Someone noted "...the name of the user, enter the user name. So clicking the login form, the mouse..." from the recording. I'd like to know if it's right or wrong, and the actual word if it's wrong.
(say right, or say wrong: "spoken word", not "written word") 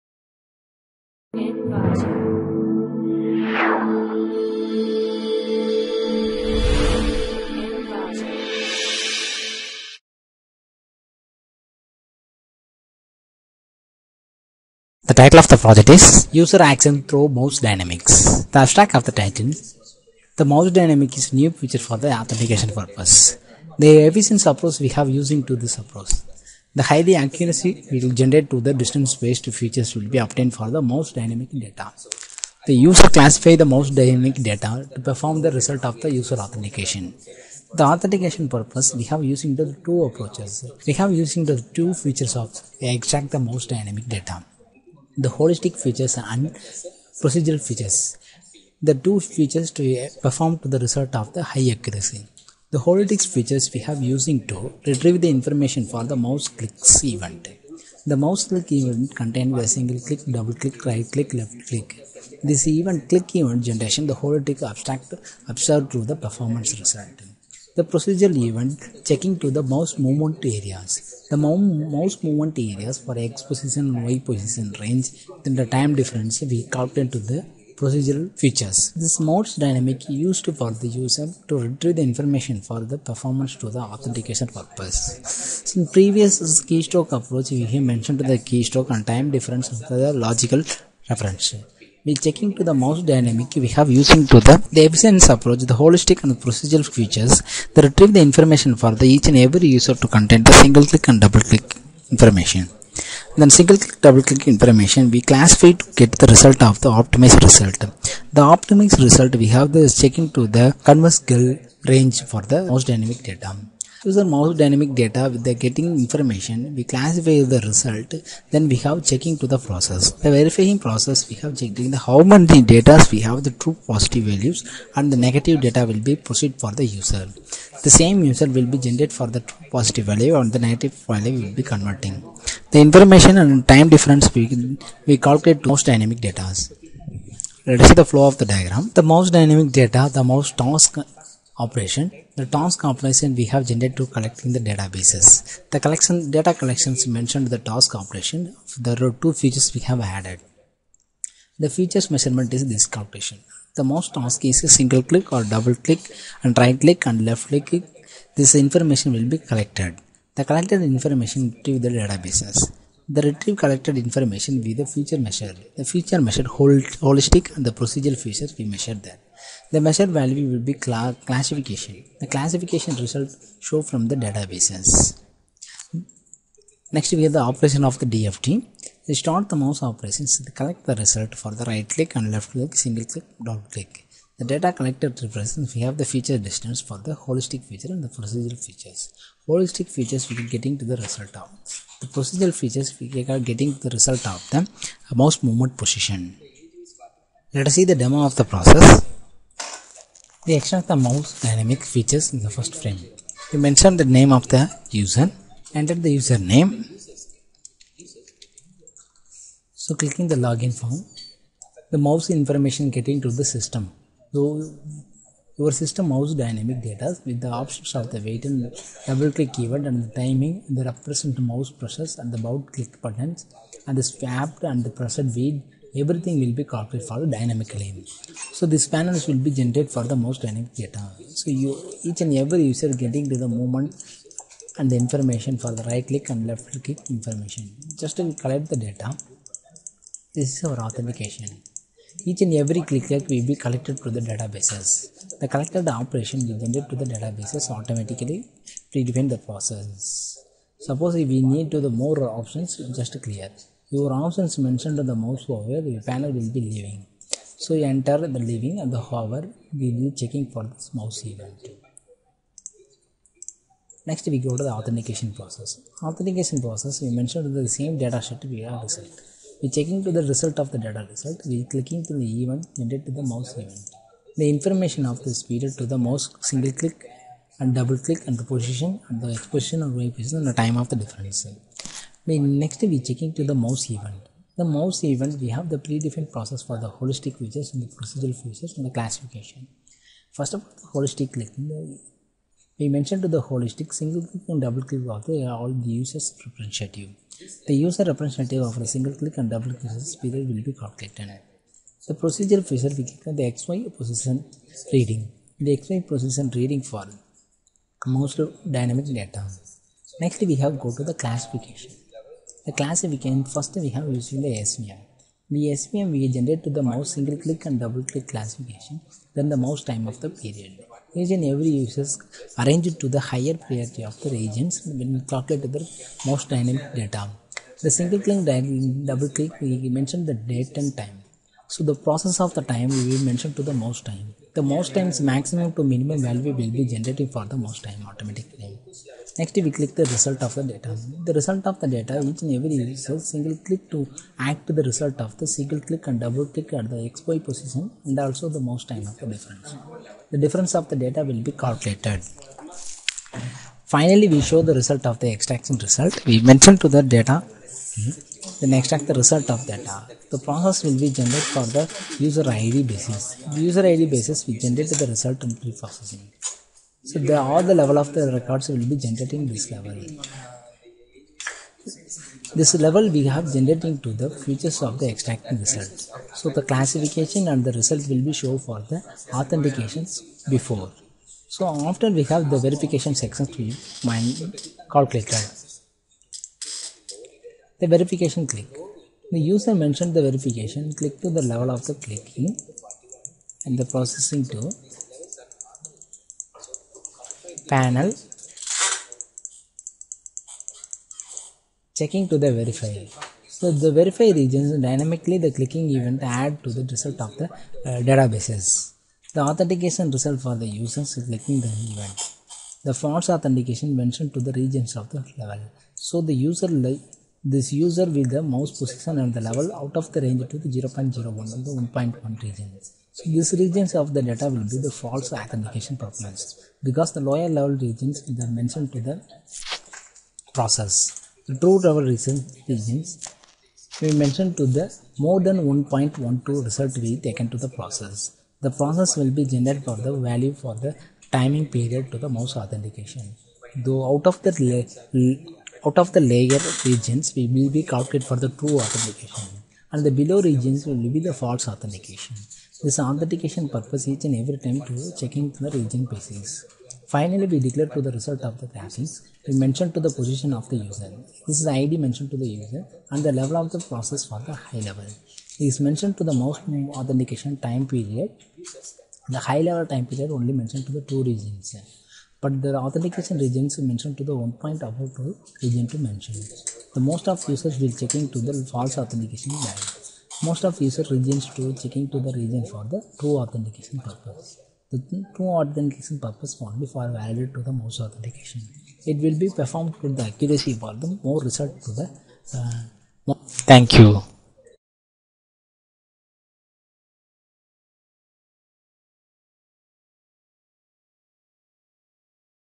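right.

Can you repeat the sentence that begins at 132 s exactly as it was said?
The information and time difference we, we calculate mouse dynamic data.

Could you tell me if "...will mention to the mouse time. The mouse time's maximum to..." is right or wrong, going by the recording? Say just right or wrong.
right.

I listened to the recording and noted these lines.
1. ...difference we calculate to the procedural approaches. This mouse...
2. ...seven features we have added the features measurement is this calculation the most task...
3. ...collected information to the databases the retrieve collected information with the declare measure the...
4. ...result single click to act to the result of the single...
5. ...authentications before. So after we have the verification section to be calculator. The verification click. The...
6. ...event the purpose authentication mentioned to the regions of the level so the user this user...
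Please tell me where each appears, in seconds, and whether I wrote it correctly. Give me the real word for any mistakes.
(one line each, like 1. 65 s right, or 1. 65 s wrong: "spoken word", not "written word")
1. 75 s wrong: "features", not "approaches"
2. 149 s wrong: "two", not "seven"
3. 160 s wrong: "feature", not "declare"
4. 342 s right
5. 379 s right
6. 411 s wrong: "false", not "purpose".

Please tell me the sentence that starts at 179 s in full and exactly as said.
It is start the mouse operations the collect the result for the right click and left click, single click, double click.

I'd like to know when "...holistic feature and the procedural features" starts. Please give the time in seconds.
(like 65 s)
187 s.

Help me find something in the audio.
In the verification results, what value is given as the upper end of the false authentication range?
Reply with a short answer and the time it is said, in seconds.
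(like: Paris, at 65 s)
1.1, at 421 s.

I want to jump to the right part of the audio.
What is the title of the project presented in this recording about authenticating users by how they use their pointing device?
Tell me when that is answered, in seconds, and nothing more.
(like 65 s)
16 s.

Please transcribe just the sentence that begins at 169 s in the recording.
The measured value will be cl- classification.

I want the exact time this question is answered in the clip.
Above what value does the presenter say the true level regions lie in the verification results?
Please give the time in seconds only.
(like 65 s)
435 s.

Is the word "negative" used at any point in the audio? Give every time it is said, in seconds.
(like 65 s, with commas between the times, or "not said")
125 s, 130 s.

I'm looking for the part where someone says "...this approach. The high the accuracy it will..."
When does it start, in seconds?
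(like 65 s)
25 s.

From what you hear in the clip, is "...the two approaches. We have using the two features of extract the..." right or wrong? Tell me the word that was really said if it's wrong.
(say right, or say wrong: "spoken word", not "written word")
right.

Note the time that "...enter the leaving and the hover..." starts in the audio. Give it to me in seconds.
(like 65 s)
257 s.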